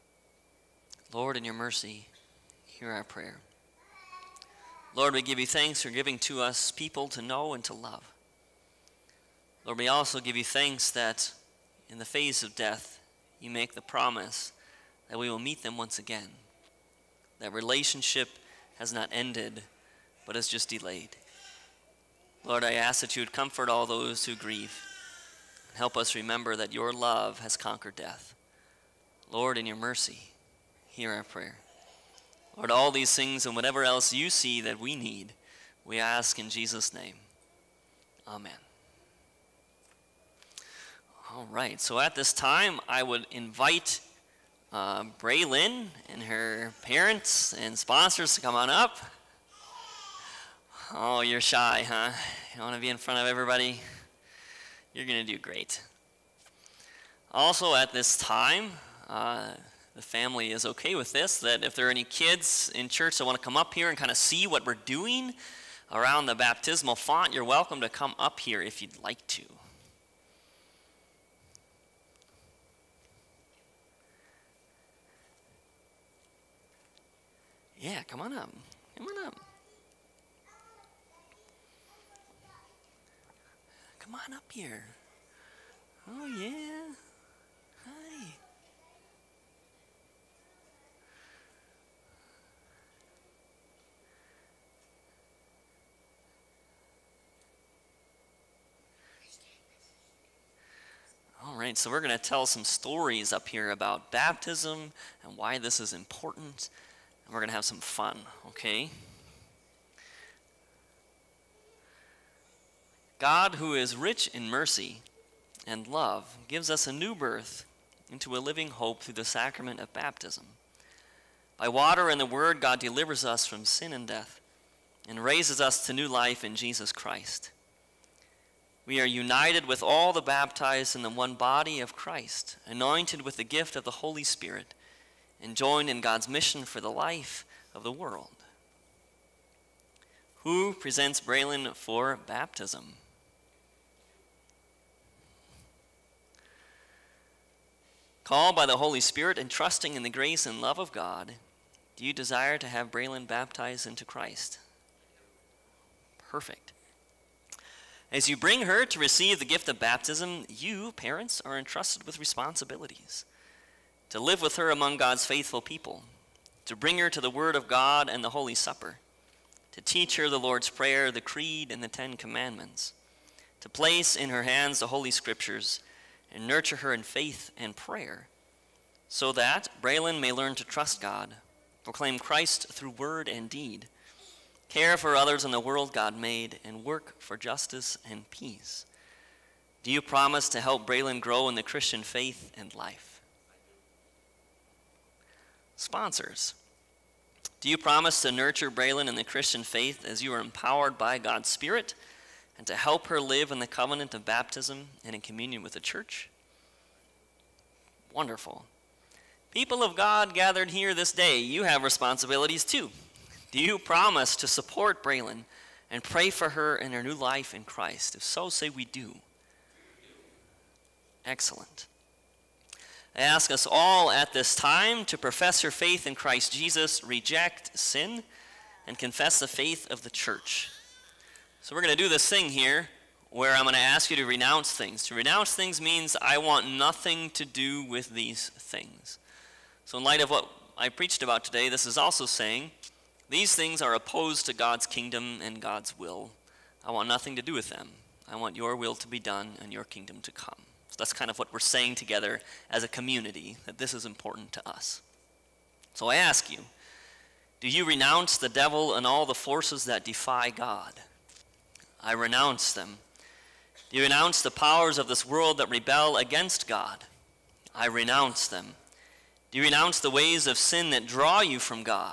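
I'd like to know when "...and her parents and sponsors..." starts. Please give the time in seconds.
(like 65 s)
46 s.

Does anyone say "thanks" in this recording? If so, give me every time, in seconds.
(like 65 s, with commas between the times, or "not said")
5 s, 10 s.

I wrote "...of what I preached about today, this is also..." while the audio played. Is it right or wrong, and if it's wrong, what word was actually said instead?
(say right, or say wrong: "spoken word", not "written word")
right.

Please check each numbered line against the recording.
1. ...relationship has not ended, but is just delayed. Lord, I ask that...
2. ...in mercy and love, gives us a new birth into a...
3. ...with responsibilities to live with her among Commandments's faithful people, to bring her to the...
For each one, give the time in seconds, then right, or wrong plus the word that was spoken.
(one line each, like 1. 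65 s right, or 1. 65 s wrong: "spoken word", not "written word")
1. 17 s right
2. 114 s right
3. 162 s wrong: "God", not "Commandments".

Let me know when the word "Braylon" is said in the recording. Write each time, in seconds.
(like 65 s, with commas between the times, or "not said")
45 s, 141 s, 152 s, 179 s, 190 s, 198 s, 215 s.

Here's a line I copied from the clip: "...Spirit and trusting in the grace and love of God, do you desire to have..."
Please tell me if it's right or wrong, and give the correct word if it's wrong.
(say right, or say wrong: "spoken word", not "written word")
right.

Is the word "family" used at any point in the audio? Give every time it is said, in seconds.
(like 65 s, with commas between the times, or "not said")
60 s.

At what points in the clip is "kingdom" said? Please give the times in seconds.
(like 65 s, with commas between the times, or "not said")
244 s, 249 s.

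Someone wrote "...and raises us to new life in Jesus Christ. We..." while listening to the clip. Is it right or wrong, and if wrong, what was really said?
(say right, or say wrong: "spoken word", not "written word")
right.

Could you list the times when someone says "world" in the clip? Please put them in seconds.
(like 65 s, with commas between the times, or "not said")
137 s, 185 s, 265 s.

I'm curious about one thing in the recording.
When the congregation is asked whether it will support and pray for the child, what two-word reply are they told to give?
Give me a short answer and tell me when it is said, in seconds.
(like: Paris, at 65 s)
We do, at 218 s.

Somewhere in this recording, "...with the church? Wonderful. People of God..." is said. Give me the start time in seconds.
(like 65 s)
205 s.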